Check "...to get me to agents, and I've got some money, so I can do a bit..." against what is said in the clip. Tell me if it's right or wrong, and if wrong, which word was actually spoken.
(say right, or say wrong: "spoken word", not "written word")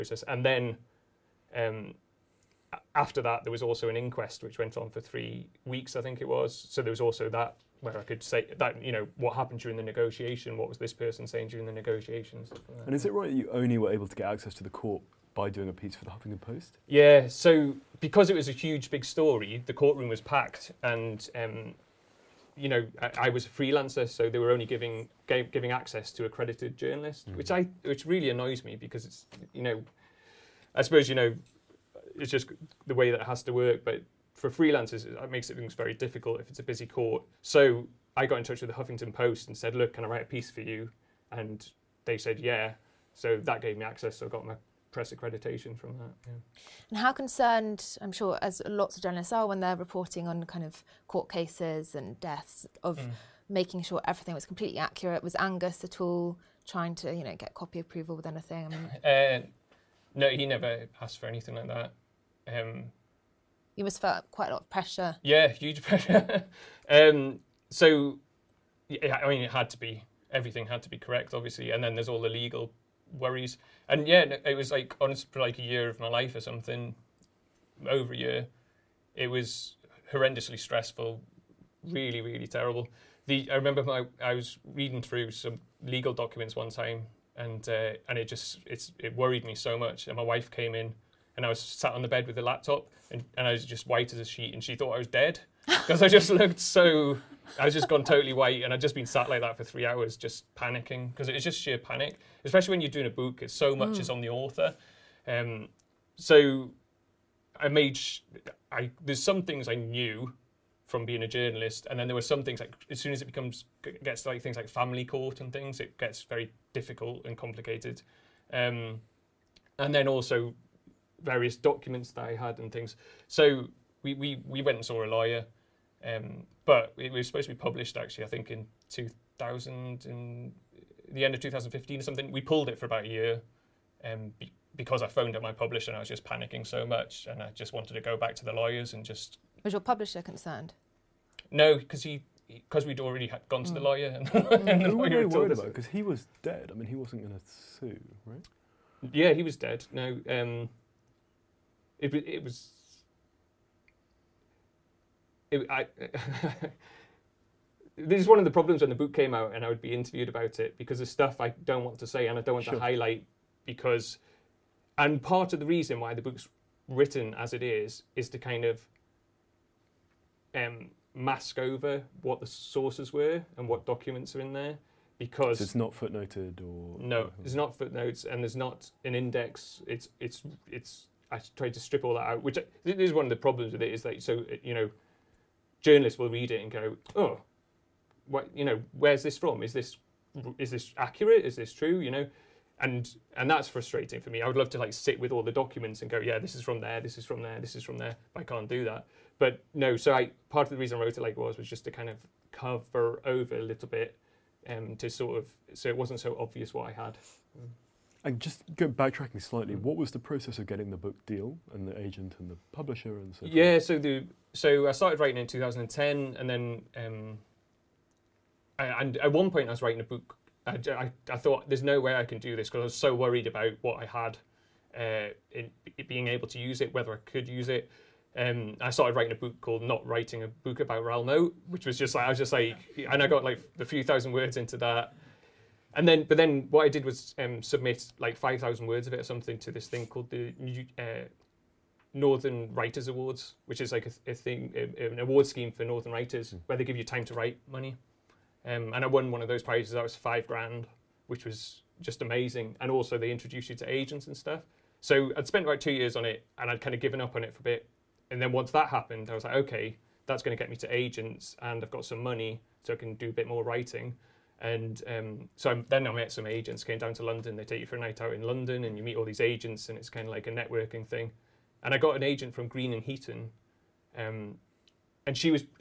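right.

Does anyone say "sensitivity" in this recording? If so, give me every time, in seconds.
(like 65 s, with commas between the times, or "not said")
not said.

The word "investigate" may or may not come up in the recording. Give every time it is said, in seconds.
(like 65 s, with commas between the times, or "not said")
not said.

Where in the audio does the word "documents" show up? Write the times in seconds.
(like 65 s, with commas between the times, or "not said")
86 s, 121 s, 173 s, 195 s.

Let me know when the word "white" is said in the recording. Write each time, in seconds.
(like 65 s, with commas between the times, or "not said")
93 s, 98 s.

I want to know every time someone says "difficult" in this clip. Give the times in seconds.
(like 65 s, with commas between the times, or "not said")
35 s, 116 s.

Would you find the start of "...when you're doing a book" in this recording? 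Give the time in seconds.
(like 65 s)
102 s.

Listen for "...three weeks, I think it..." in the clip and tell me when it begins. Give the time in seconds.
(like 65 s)
5 s.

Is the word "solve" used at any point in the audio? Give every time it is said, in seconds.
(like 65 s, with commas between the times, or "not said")
not said.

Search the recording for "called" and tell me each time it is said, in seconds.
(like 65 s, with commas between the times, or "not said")
229 s, 240 s.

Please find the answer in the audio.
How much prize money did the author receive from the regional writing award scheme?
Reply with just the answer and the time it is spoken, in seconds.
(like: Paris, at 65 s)
5 grand, at 250 s.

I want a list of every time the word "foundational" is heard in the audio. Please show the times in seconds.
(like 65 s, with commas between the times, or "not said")
not said.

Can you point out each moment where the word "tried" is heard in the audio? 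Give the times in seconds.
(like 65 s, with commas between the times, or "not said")
181 s.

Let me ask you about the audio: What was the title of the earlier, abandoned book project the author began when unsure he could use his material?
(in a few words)
Not Writing a Book About Raoul Moat.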